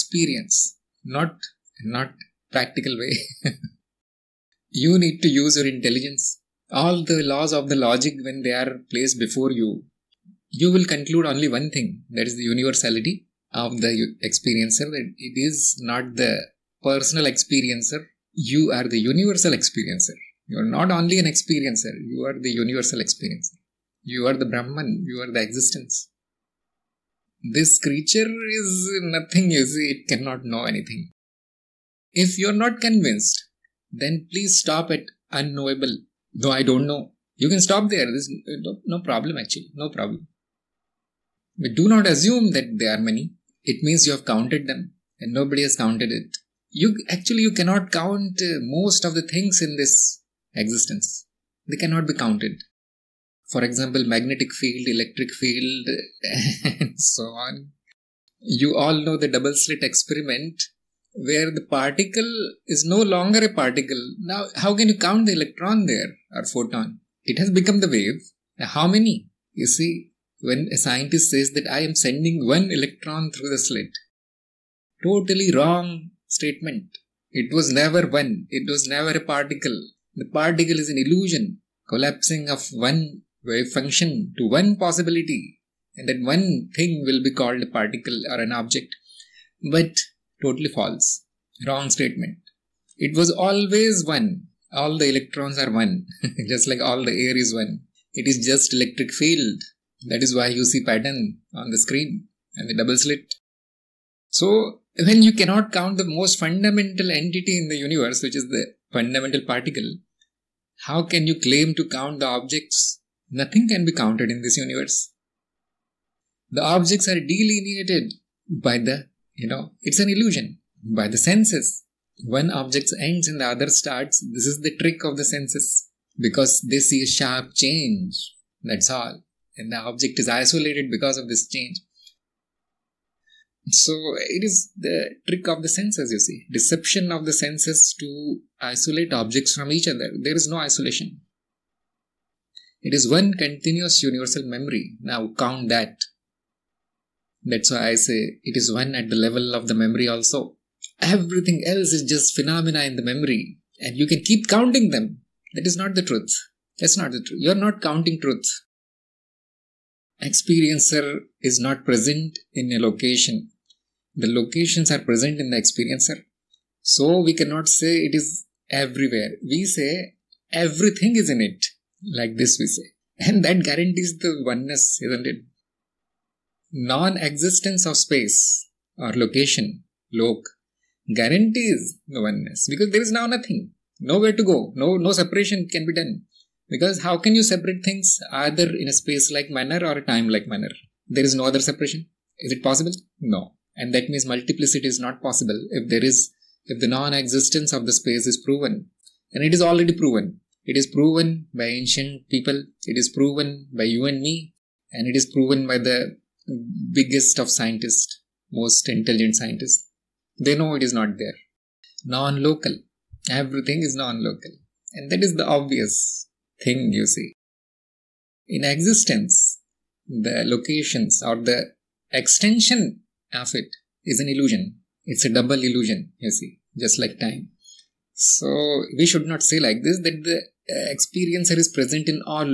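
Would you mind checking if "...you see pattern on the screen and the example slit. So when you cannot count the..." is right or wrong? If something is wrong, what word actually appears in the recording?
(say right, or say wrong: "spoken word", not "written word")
wrong: "double", not "example".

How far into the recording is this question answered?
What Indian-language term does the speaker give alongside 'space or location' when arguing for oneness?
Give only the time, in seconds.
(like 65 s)
180 s.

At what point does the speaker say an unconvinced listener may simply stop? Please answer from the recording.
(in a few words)
unknowable.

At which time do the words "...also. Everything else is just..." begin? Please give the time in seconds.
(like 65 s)
150 s.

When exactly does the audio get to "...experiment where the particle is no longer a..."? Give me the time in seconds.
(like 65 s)
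59 s.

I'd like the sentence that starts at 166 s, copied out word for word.
So we cannot say it is everywhere.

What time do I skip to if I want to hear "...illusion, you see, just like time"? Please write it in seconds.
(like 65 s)
225 s.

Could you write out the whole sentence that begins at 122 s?
One object ends and the other starts.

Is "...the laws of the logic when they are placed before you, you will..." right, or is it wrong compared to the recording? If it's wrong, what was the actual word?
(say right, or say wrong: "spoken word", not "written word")
right.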